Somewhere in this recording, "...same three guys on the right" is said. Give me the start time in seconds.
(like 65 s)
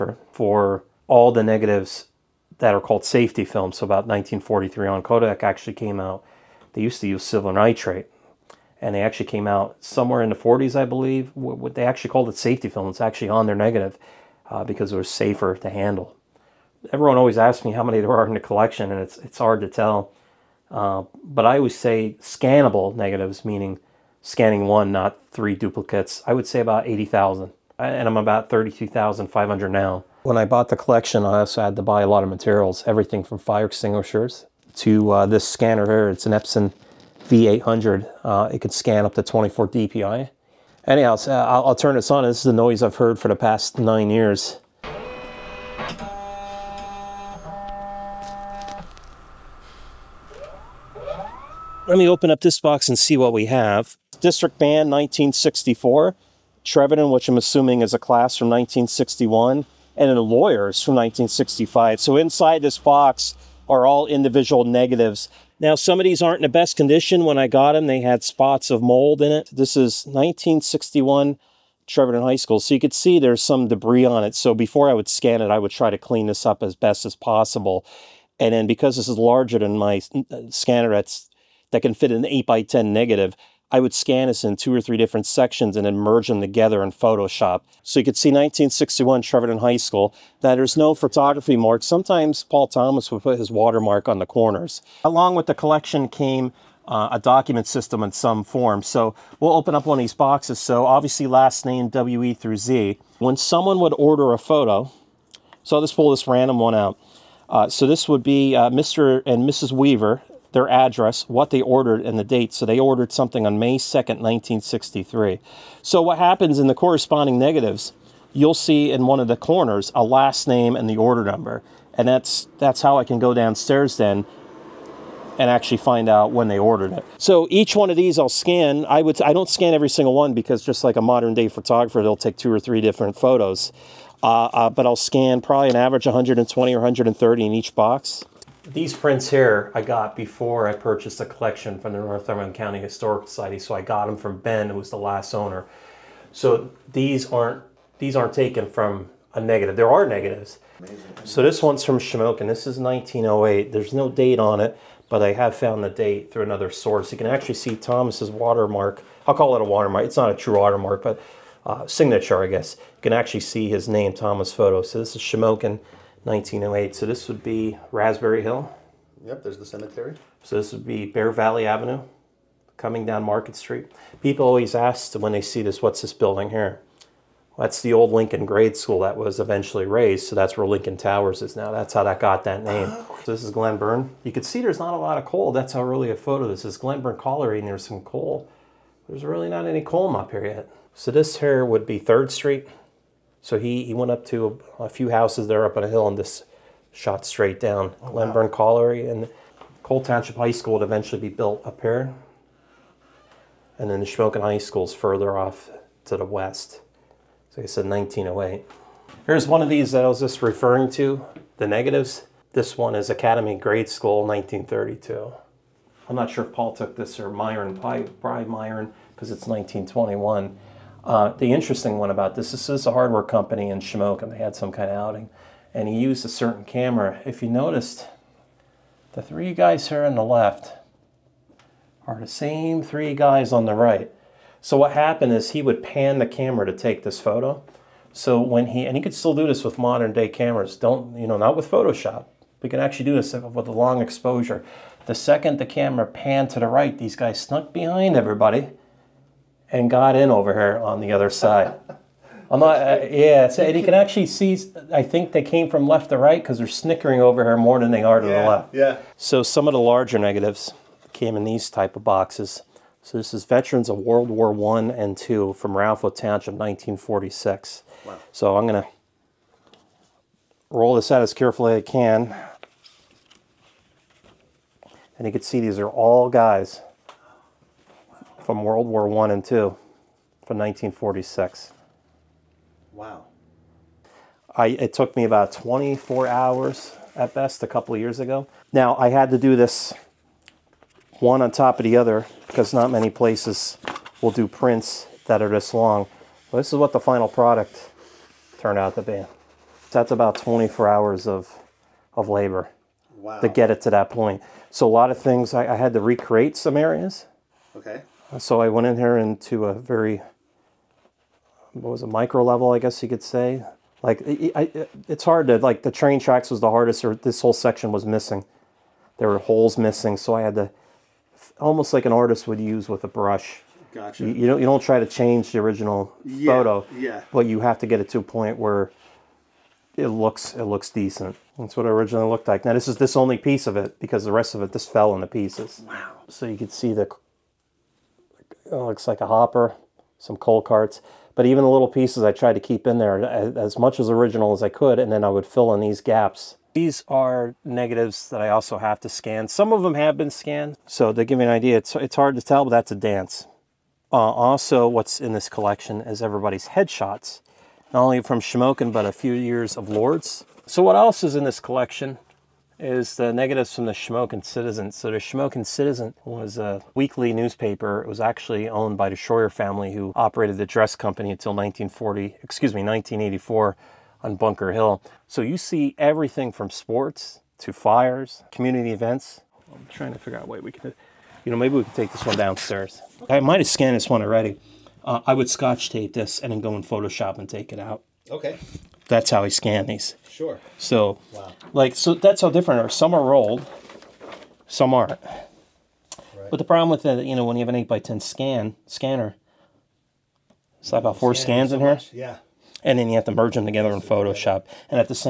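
232 s.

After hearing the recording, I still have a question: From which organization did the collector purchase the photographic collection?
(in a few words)
Northumberland County Historic Society.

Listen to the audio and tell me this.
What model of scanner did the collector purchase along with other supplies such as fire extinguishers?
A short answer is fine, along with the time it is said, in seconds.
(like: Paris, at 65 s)
Epson V800, at 36 s.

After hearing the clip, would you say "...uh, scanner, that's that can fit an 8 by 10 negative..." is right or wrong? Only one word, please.
right.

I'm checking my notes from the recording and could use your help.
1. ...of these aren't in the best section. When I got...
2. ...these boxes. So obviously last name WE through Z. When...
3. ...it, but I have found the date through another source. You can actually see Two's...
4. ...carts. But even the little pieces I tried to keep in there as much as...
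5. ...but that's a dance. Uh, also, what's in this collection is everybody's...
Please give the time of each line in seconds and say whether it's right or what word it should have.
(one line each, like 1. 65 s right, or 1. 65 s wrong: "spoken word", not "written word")
1. 65 s wrong: "condition", not "section"
2. 100 s right
3. 154 s wrong: "Thomas", not "Two"
4. 340 s right
5. 352 s right.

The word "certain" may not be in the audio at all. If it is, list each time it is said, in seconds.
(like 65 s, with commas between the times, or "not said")
226 s.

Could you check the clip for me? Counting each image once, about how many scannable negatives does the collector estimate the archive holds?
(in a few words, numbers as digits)
80,000.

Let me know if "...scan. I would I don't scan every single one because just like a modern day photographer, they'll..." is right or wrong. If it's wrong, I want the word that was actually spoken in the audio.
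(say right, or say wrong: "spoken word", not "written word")
right.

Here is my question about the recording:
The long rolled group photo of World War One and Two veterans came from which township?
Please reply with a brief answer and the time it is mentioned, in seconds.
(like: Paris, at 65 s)
Ralpho Township, at 265 s.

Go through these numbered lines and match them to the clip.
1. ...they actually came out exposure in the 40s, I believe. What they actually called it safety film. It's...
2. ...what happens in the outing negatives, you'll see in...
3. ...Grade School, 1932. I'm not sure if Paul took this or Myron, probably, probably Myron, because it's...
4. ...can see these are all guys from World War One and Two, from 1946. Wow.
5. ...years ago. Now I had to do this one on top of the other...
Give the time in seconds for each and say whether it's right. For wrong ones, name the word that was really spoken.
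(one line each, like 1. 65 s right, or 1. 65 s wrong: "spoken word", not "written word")
1. 8 s wrong: "somewhere", not "exposure"
2. 116 s wrong: "corresponding", not "outing"
3. 213 s right
4. 275 s right
5. 288 s right.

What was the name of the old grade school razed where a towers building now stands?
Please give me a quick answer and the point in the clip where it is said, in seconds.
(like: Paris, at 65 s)
Lincoln Grade School, at 178 s.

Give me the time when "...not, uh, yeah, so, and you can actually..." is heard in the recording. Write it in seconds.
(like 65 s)
252 s.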